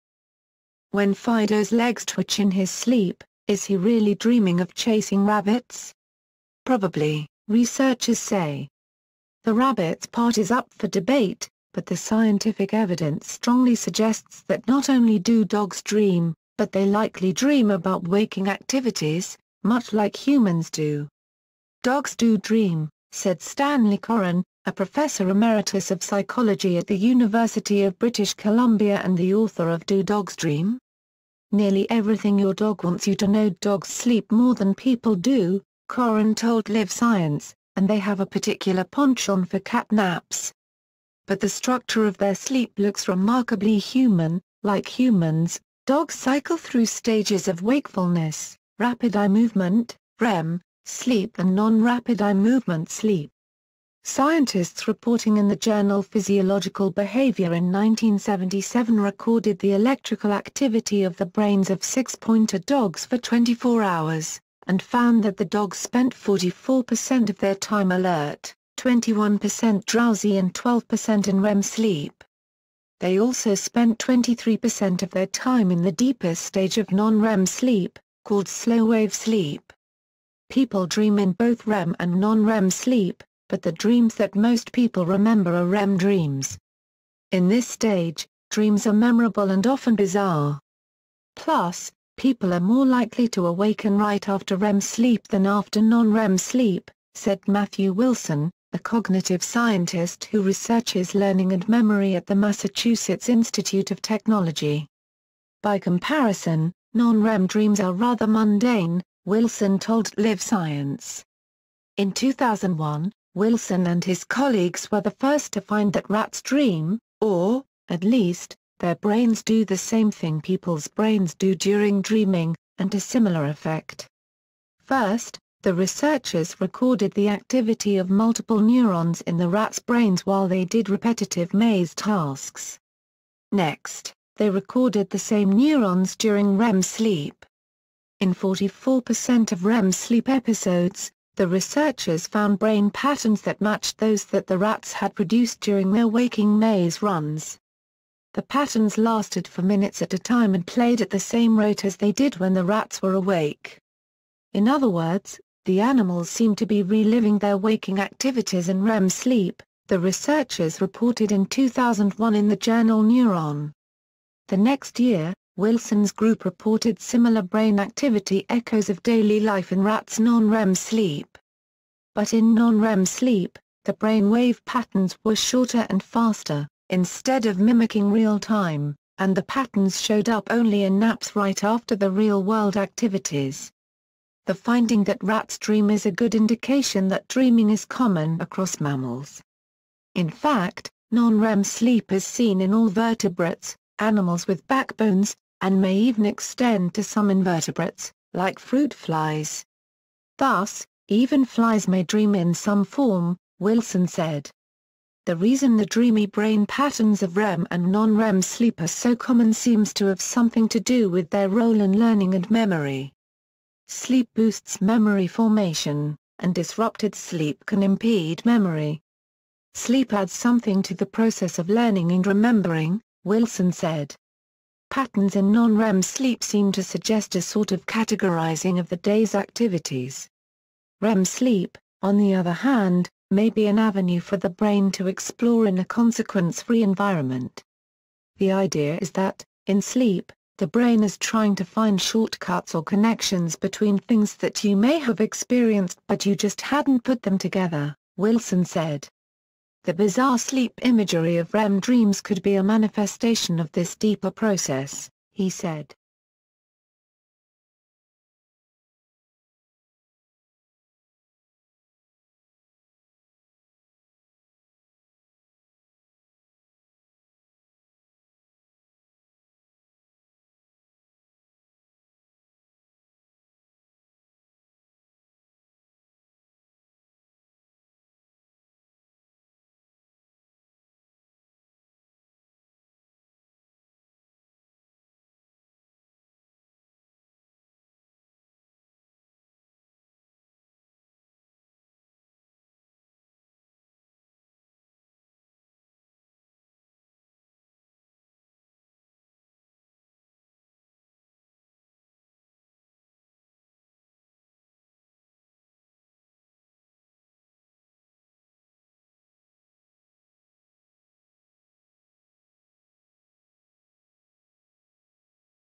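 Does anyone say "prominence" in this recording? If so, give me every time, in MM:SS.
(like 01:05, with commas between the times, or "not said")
not said.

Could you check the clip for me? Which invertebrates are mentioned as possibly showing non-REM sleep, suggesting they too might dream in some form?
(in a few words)
Fruit flies.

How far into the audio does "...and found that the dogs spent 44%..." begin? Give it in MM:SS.
01:04.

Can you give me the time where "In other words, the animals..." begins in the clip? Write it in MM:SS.
02:34.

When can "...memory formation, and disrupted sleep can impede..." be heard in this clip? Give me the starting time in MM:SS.
03:34.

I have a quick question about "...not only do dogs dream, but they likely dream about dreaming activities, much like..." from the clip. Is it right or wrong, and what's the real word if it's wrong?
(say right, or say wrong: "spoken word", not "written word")
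wrong: "waking", not "dreaming".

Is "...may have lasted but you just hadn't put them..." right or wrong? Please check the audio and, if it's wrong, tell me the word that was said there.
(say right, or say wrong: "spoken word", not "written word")
wrong: "experienced", not "lasted".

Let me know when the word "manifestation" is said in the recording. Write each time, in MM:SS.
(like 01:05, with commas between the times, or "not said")
04:12.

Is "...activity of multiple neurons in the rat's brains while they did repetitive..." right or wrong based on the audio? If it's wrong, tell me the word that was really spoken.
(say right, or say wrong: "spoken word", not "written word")
right.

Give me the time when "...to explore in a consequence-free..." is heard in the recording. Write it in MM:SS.
03:54.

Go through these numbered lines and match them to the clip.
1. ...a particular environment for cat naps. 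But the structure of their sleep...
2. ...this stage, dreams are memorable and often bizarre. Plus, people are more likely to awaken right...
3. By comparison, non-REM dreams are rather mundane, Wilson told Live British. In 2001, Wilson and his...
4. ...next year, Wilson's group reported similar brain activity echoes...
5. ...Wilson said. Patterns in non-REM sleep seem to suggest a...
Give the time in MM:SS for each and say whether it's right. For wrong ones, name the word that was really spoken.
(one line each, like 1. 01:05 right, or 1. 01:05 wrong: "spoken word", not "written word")
1. 00:38 wrong: "penchant", not "environment"
2. 01:27 right
3. 01:45 wrong: "Science", not "British"
4. 02:44 right
5. 03:43 right.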